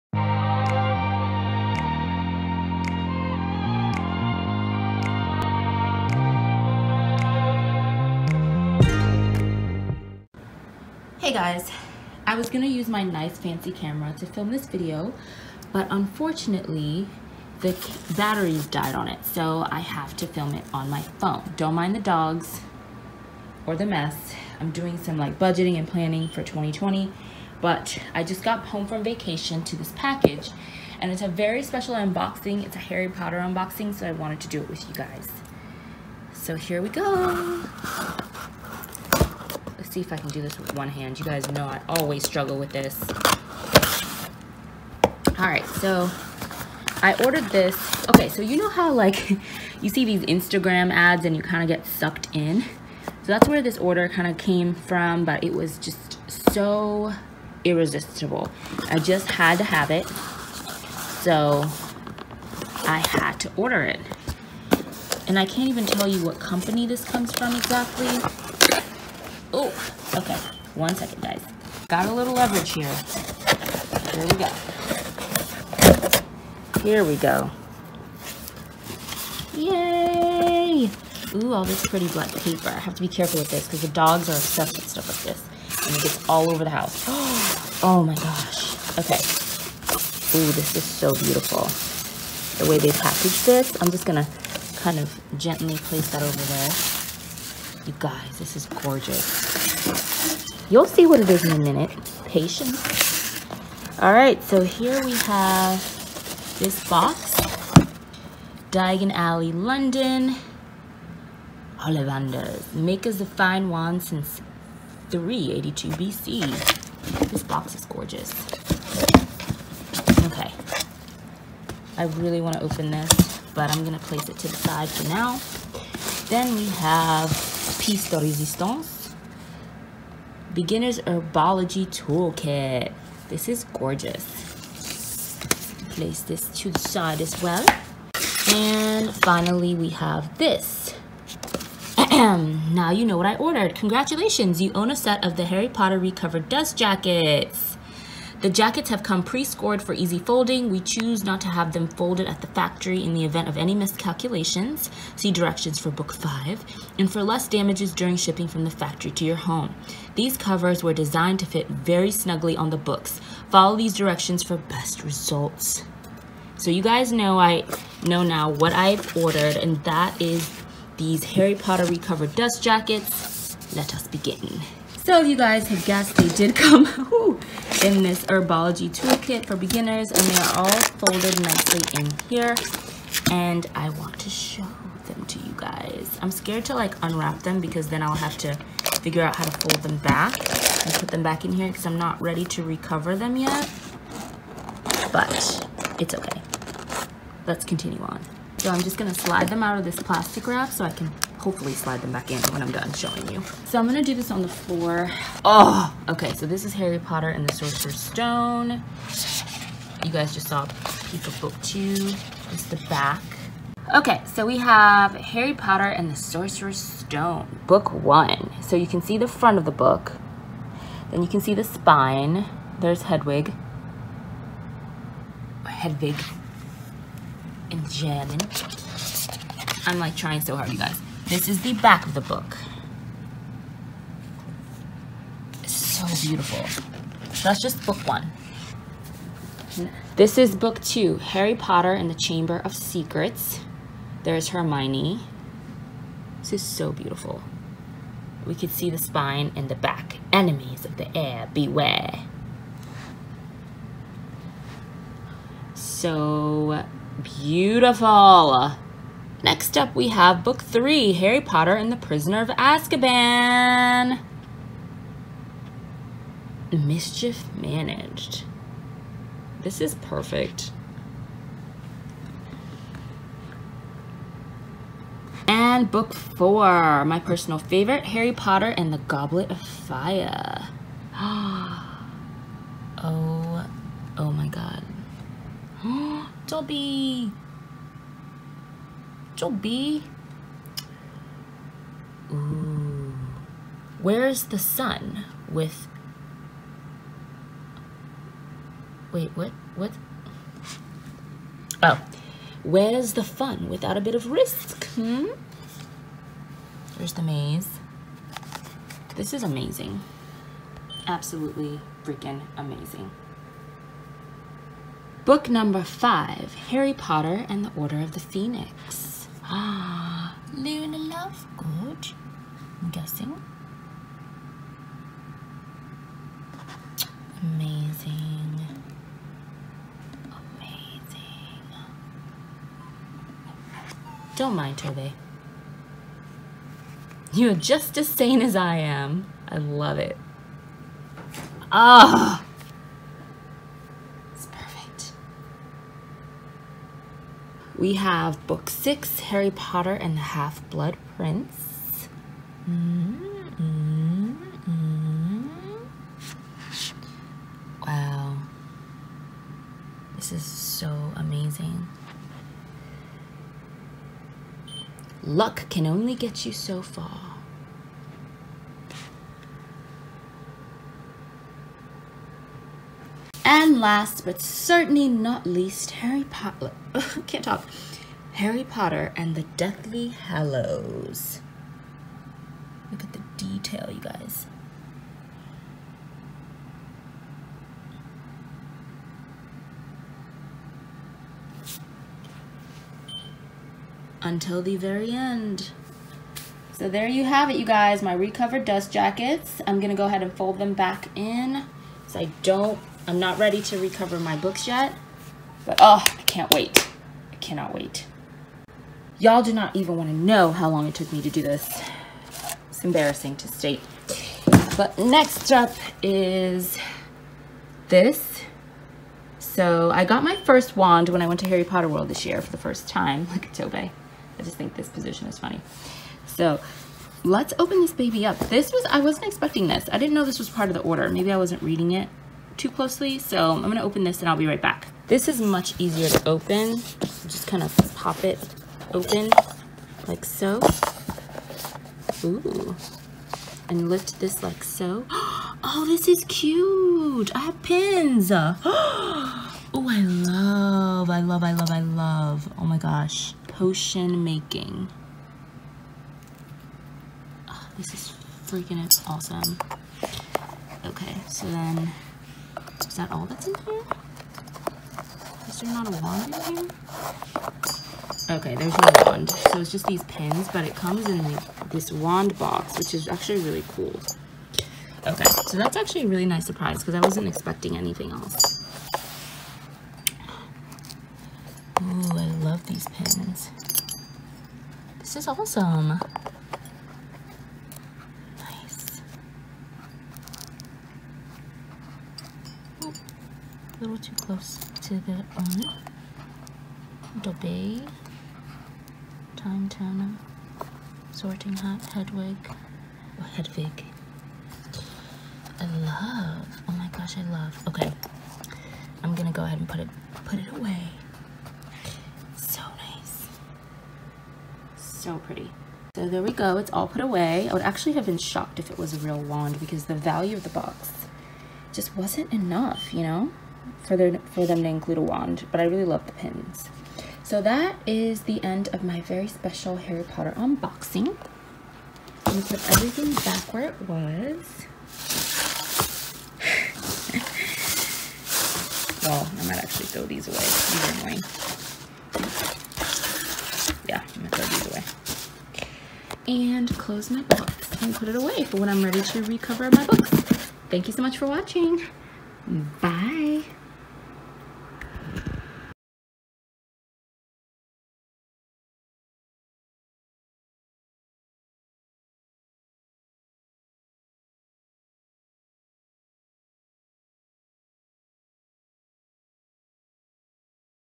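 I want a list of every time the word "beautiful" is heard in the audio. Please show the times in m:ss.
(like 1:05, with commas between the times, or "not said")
1:31, 3:56, 4:06, 4:17.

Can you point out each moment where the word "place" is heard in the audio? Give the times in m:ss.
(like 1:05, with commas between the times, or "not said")
1:35, 2:04, 2:15.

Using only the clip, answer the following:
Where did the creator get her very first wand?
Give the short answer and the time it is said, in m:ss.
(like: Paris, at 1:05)
Harry Potter World, at 7:01.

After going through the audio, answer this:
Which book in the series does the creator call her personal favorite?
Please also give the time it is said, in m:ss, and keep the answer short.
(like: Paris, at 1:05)
Goblet of Fire, at 4:38.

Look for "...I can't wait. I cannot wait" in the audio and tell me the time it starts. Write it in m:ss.
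6:46.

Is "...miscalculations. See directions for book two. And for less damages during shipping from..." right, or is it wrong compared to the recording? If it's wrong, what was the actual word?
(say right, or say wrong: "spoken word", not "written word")
wrong: "five", not "two".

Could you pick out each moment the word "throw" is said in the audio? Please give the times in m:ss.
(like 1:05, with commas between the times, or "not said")
8:59, 9:04.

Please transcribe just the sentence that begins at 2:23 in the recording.
Congratulations, you own a set of the Harry Potter Recovered Dust Jackets.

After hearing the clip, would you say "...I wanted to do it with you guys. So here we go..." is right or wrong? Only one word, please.
right.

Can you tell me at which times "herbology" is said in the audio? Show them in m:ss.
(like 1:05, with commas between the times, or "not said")
2:11, 2:58.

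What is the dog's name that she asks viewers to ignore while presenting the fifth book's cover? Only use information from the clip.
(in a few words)
Toby.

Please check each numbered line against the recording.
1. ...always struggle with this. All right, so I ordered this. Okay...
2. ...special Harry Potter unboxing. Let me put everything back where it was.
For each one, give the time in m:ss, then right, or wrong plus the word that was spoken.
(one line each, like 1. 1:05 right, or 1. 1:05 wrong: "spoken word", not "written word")
1. 0:41 right
2. 8:49 right.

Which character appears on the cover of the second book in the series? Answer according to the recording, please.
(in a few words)
Hermione.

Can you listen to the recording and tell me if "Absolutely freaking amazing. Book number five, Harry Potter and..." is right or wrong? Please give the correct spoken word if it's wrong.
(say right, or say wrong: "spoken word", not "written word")
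right.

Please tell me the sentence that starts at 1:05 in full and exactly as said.
And I can't even tell you what company this comes from exactly.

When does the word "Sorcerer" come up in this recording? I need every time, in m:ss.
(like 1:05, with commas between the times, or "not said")
3:27, 3:36.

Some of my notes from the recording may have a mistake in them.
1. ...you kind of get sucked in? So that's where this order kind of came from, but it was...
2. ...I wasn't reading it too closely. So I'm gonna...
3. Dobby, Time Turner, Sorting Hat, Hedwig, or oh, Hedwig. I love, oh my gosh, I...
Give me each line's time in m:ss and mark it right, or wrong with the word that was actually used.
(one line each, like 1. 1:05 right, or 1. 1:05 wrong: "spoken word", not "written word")
1. 0:51 right
2. 7:11 right
3. 8:17 right.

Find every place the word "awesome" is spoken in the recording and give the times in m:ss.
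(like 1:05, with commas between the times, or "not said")
7:39, 8:05.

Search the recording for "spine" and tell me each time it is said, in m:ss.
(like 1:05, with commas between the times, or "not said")
3:41, 4:08.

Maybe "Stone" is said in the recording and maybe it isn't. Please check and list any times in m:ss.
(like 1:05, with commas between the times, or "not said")
3:27, 3:36.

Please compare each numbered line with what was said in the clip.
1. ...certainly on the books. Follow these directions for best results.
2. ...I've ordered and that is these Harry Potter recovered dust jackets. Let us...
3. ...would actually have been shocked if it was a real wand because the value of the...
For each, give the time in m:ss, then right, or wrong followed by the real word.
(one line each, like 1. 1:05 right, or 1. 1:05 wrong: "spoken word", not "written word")
1. 2:42 wrong: "snugly", not "certainly"
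2. 2:48 right
3. 8:37 right.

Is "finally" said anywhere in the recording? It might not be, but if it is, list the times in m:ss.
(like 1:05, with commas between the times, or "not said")
2:19.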